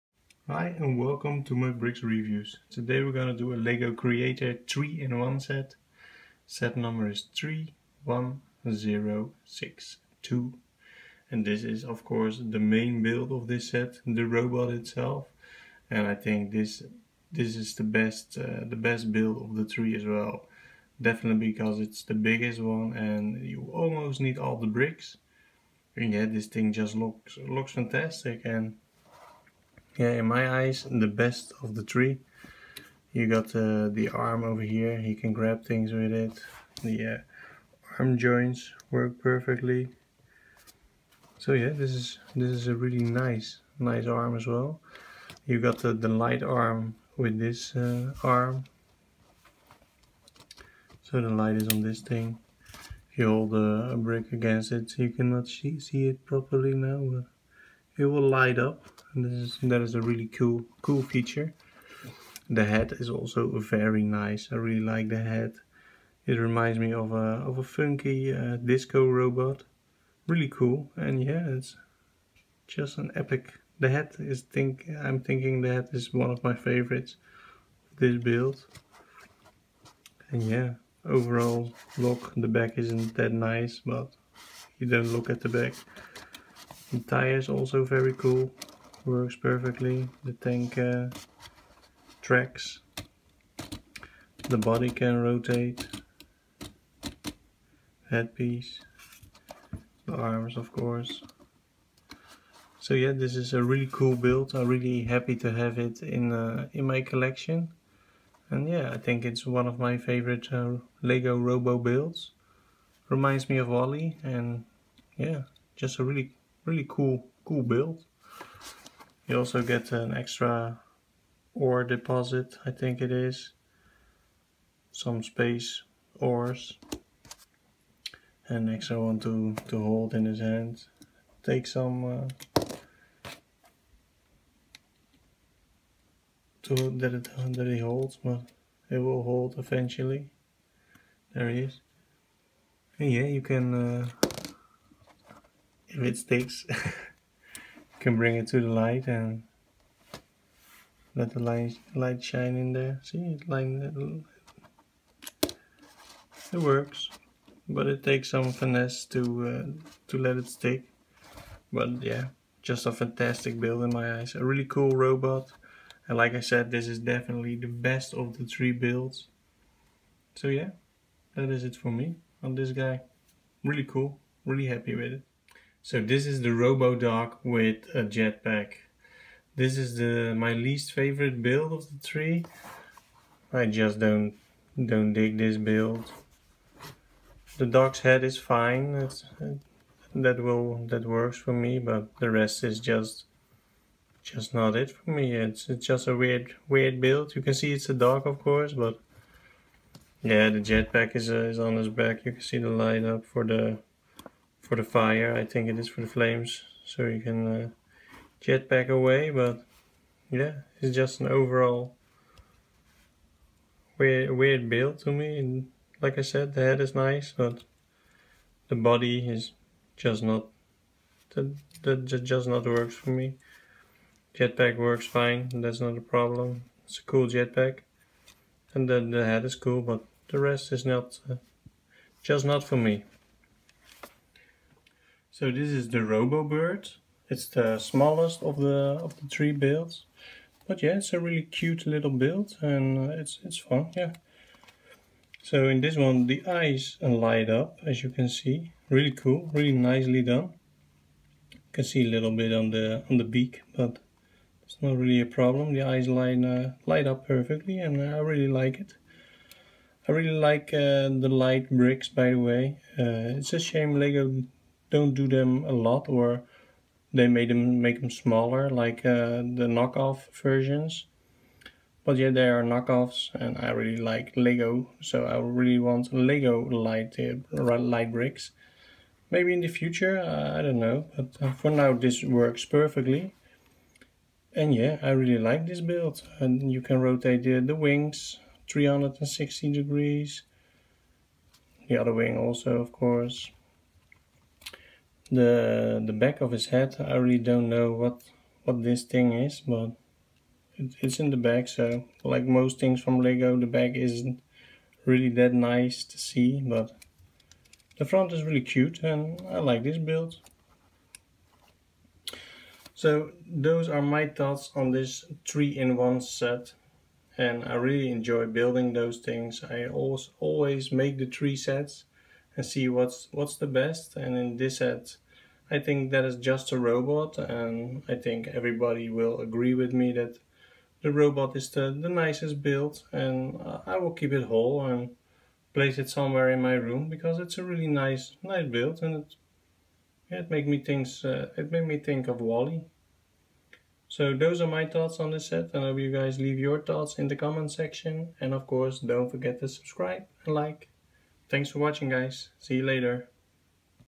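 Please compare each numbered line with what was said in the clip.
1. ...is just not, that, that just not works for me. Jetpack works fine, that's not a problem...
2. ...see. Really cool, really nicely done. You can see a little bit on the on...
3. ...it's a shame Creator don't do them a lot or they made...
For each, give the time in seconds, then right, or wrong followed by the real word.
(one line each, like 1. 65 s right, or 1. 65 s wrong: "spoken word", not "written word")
1. 219 s right
2. 248 s right
3. 263 s wrong: "Lego", not "Creator".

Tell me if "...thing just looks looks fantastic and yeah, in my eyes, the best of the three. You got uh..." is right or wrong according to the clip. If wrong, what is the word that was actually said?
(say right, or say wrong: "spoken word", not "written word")
right.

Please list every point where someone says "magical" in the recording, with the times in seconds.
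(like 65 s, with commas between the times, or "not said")
not said.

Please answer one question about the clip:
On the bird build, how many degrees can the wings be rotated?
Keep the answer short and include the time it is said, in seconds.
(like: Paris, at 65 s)
360, at 288 s.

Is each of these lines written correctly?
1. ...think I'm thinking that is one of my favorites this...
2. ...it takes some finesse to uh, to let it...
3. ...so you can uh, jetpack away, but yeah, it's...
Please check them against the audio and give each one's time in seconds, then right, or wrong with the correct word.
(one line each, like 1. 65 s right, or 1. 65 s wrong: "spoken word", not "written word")
1. 74 s right
2. 157 s right
3. 206 s right.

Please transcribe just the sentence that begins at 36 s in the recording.
The uh, arm joints work perfectly.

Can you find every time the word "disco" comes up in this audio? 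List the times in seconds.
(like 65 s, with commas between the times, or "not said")
68 s.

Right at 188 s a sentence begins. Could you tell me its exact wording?
That's that will that works for me, but the rest is just just not it for me.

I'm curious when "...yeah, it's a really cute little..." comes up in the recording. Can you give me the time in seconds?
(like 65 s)
240 s.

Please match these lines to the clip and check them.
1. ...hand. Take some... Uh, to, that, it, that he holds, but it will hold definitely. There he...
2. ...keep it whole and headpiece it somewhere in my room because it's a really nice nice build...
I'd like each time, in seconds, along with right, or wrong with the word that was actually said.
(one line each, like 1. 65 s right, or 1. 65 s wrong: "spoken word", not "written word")
1. 130 s wrong: "eventually", not "definitely"
2. 334 s wrong: "place", not "headpiece".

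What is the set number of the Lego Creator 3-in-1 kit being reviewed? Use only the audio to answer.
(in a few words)
31062.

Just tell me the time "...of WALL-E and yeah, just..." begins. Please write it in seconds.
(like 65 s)
113 s.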